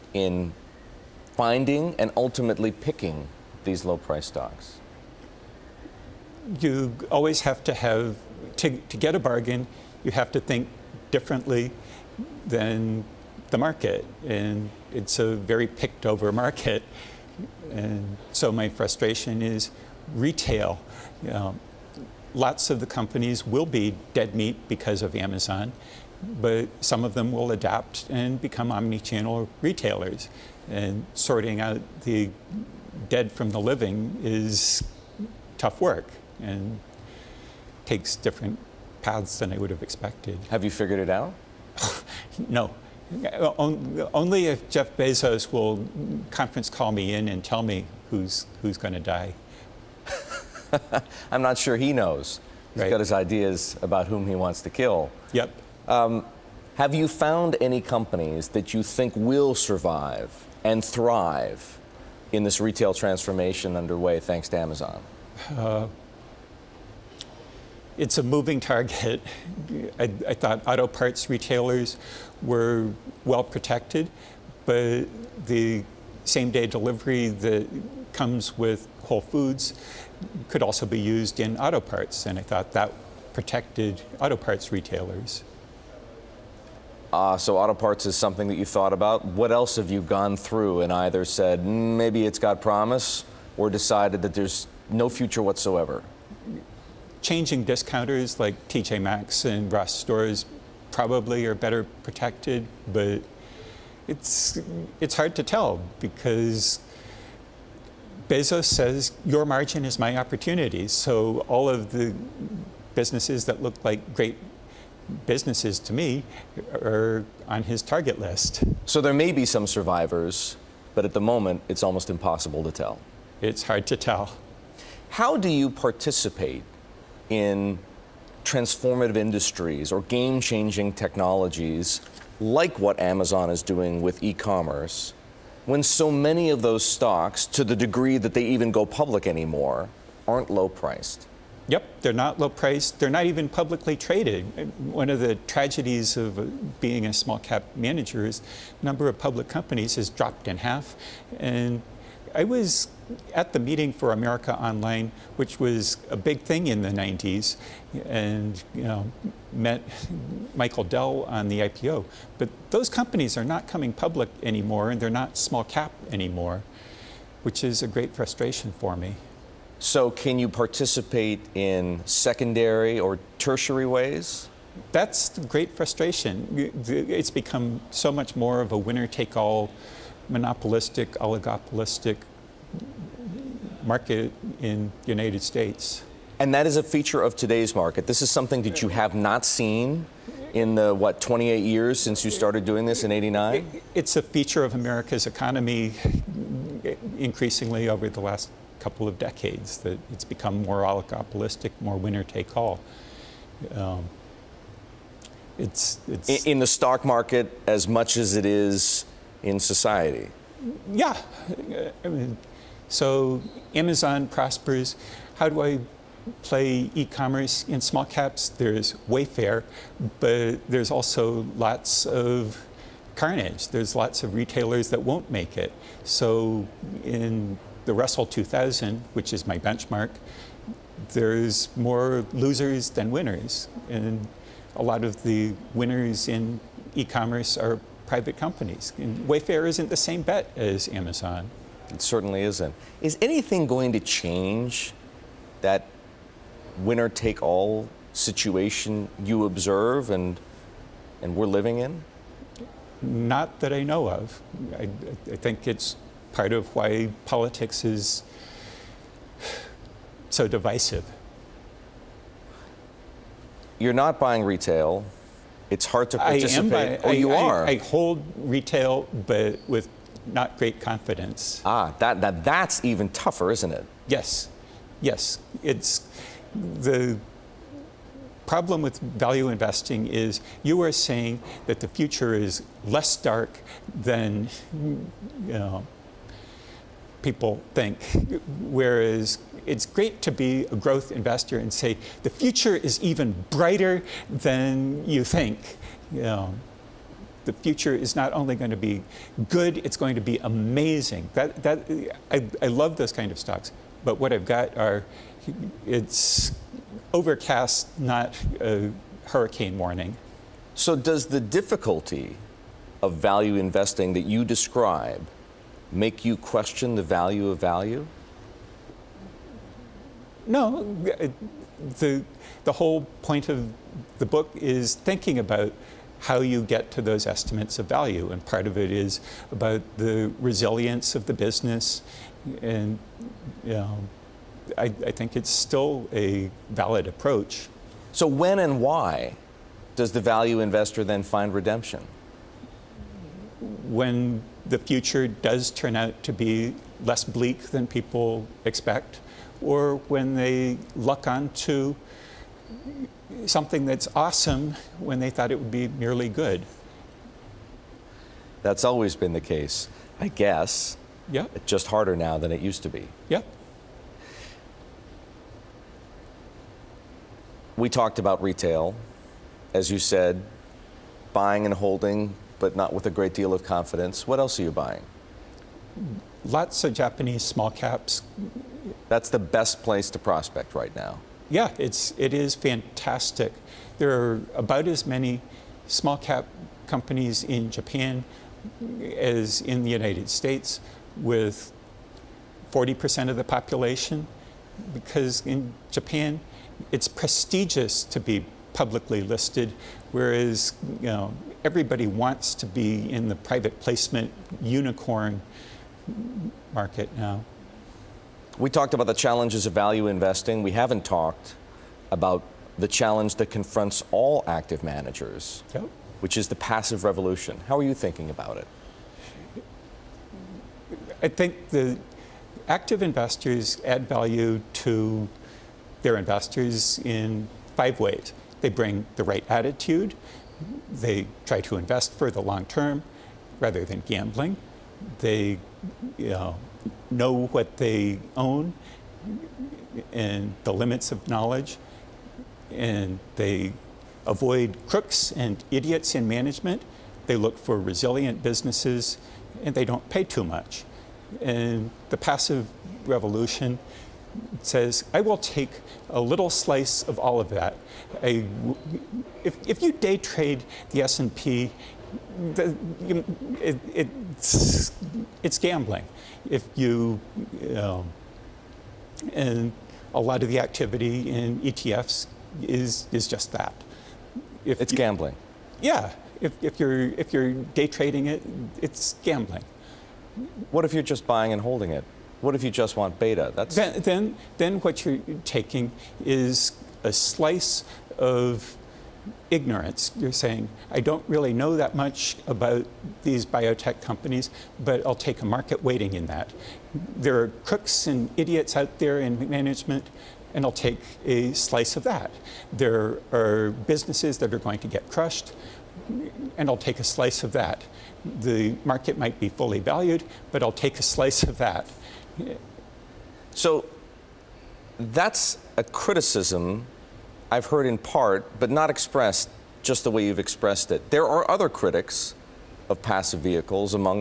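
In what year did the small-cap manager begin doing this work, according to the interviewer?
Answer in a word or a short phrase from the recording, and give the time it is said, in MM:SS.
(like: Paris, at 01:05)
1989, at 03:13.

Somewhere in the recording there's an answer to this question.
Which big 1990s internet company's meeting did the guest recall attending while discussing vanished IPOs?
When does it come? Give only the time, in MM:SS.
02:34.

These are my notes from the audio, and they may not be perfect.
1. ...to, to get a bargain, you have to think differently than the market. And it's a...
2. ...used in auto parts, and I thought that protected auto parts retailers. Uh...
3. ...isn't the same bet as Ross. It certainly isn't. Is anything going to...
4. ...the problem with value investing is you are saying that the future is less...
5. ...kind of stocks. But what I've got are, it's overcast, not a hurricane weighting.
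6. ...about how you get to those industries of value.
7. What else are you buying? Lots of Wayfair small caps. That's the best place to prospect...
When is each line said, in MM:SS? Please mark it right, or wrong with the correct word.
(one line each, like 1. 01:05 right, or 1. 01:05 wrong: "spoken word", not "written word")
1. 00:08 right
2. 01:20 right
3. 03:59 wrong: "Amazon", not "Ross"
4. 04:36 right
5. 05:03 wrong: "warning", not "weighting"
6. 05:25 wrong: "estimates", not "industries"
7. 06:14 wrong: "Japanese", not "Wayfair".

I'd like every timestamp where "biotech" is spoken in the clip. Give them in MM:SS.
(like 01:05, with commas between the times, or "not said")
08:13.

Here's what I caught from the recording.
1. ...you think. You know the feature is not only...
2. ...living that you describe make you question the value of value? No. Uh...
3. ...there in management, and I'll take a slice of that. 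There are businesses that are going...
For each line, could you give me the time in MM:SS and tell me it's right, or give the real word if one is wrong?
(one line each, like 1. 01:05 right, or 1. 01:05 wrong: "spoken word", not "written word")
1. 04:55 wrong: "future", not "feature"
2. 05:13 wrong: "investing", not "living"
3. 08:18 right.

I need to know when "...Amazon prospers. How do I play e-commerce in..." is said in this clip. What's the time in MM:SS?
03:33.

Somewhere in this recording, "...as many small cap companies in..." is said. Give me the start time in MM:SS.
06:24.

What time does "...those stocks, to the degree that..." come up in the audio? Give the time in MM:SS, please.
02:16.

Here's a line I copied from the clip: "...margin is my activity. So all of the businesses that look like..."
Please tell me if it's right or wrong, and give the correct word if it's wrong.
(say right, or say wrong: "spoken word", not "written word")
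wrong: "opportunity", not "activity".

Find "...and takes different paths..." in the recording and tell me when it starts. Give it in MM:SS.
00:36.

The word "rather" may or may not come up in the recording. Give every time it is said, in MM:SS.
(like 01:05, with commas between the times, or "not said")
07:13.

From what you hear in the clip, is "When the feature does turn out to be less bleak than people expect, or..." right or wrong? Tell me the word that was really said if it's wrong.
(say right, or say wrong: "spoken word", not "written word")
wrong: "future", not "feature".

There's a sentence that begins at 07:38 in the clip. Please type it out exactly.
I, if, if you day trade the S&P it, it, it's, it's gambling.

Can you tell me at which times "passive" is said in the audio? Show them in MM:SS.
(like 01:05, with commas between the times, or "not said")
06:56, 07:32, 08:43.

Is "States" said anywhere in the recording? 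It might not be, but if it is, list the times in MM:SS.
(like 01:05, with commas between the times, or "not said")
03:05, 06:30.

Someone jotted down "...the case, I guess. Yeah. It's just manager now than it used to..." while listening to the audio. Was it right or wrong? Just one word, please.
wrong.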